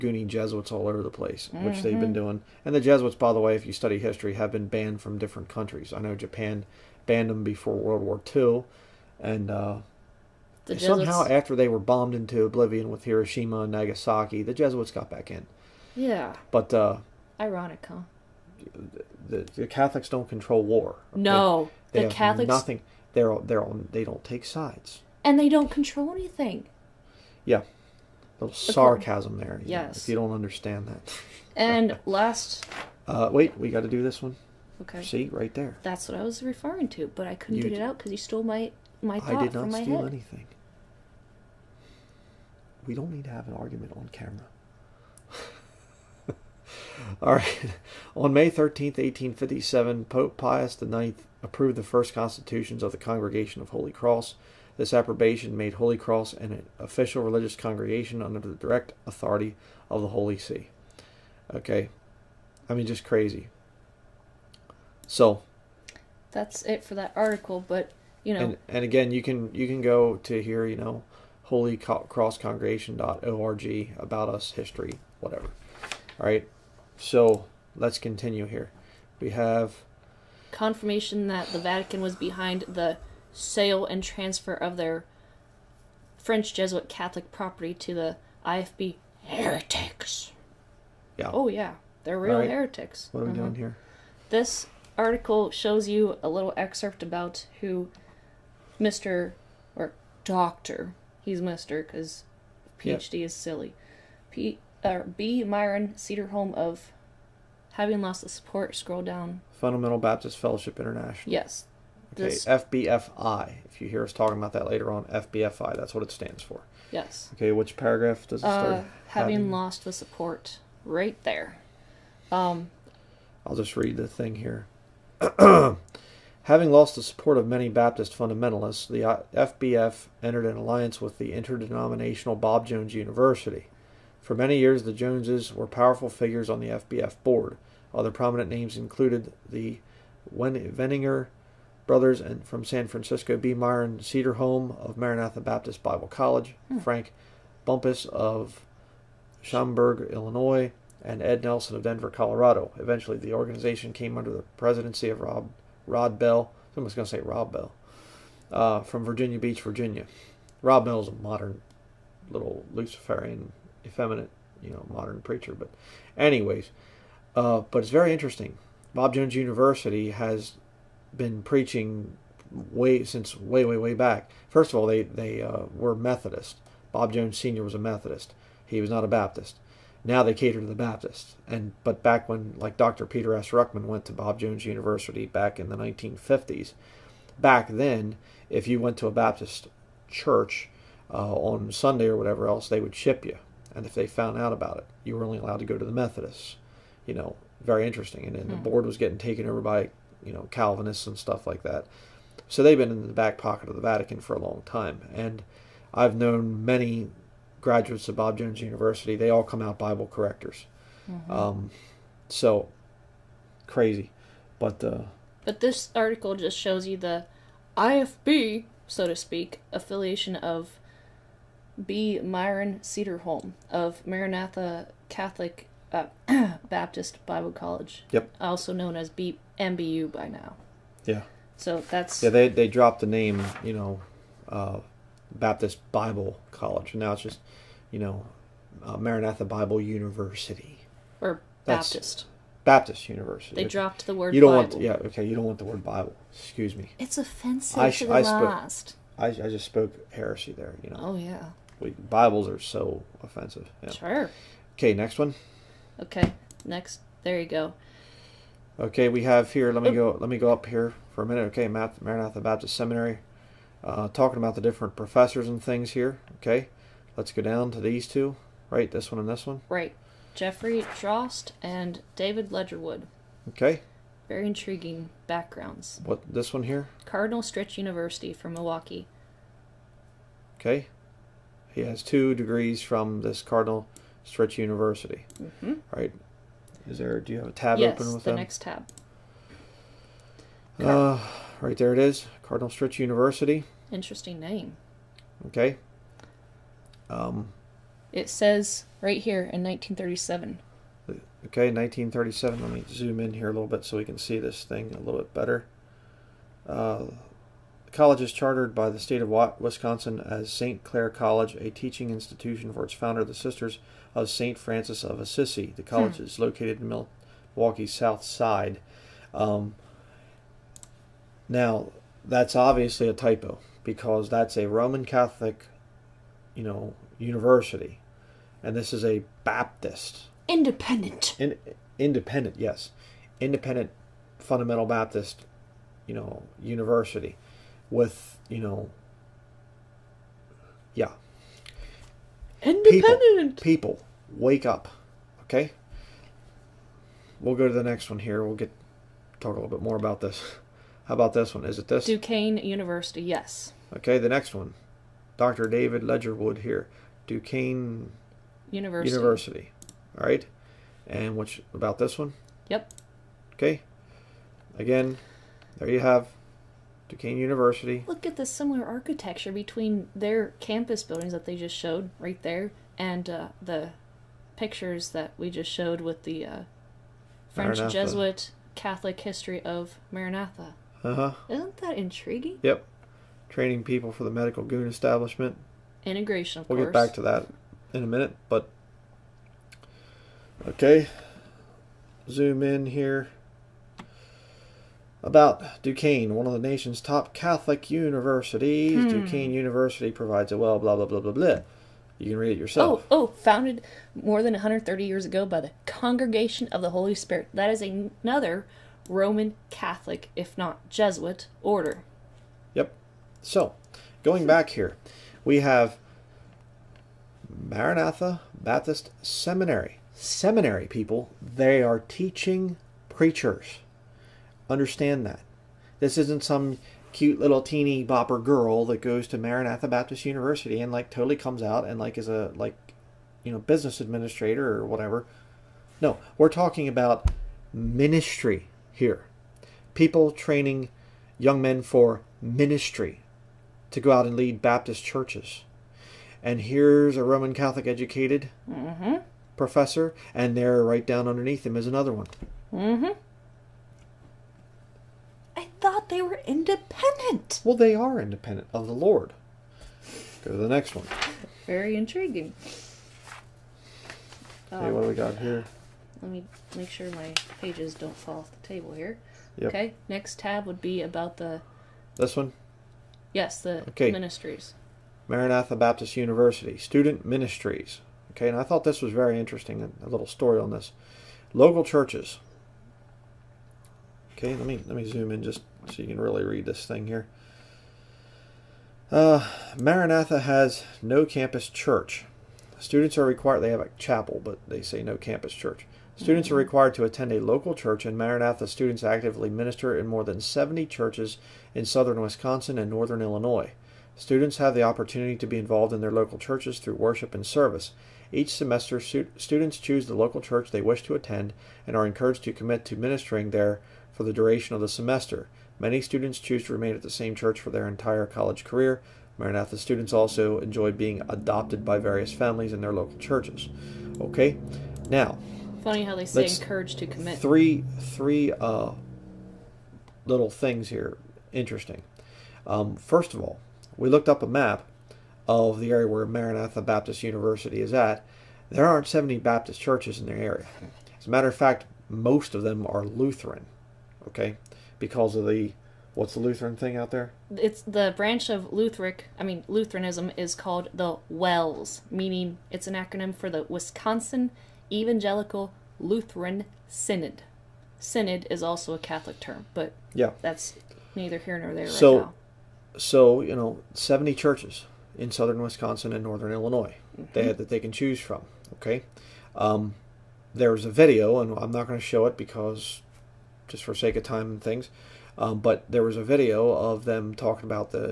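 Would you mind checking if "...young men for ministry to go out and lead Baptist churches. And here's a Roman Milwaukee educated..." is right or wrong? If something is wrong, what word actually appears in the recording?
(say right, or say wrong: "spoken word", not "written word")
wrong: "Catholic", not "Milwaukee".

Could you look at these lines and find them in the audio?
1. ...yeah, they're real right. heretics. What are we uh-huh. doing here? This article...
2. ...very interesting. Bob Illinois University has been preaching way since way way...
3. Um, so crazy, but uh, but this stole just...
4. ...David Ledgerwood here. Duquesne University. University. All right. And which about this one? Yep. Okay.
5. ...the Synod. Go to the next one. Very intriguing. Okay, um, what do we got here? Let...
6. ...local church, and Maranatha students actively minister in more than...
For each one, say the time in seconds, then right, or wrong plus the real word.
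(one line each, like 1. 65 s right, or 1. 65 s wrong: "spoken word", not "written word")
1. 91 s right
2. 167 s wrong: "Jones", not "Illinois"
3. 211 s wrong: "article", not "stole"
4. 355 s right
5. 458 s wrong: "Lord", not "Synod"
6. 497 s right.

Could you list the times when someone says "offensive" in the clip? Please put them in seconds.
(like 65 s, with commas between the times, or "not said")
247 s, 253 s.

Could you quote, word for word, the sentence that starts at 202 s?
So they've been in the back pocket of the Vatican for a long time.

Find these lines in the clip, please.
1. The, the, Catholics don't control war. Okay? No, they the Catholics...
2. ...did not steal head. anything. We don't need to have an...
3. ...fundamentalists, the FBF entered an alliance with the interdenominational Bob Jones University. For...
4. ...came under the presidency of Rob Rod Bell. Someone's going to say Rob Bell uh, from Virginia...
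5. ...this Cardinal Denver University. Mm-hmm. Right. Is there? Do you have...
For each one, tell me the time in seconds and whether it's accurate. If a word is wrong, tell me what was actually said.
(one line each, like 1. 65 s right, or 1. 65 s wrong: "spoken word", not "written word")
1. 19 s right
2. 39 s right
3. 128 s right
4. 153 s right
5. 283 s wrong: "Stritch", not "Denver".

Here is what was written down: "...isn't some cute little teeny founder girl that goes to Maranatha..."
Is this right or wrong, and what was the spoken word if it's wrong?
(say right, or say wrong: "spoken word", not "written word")
wrong: "bopper", not "founder".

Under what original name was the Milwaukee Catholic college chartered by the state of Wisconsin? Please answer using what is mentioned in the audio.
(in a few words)
St. Clare College.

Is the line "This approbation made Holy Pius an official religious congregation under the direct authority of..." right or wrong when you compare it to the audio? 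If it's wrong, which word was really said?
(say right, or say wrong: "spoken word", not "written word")
wrong: "Cross", not "Pius".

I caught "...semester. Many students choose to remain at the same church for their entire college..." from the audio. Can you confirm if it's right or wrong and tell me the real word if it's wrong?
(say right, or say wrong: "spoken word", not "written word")
right.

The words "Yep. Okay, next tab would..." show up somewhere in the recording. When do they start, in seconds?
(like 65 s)
469 s.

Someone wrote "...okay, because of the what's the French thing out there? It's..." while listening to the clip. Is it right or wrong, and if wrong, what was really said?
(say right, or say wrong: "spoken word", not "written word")
wrong: "Lutheran", not "French".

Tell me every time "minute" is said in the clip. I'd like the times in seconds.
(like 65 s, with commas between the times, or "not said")
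261 s, 388 s.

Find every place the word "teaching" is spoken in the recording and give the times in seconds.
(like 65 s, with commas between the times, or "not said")
311 s, 422 s.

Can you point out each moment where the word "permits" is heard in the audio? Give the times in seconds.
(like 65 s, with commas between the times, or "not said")
not said.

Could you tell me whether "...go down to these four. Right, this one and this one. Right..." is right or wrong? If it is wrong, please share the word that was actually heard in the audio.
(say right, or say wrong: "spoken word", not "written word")
wrong: "two", not "four".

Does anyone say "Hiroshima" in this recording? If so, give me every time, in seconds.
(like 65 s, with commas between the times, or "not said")
13 s.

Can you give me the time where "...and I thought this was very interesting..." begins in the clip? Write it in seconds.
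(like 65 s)
478 s.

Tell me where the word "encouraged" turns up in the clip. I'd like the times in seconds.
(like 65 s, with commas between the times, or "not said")
512 s, 526 s.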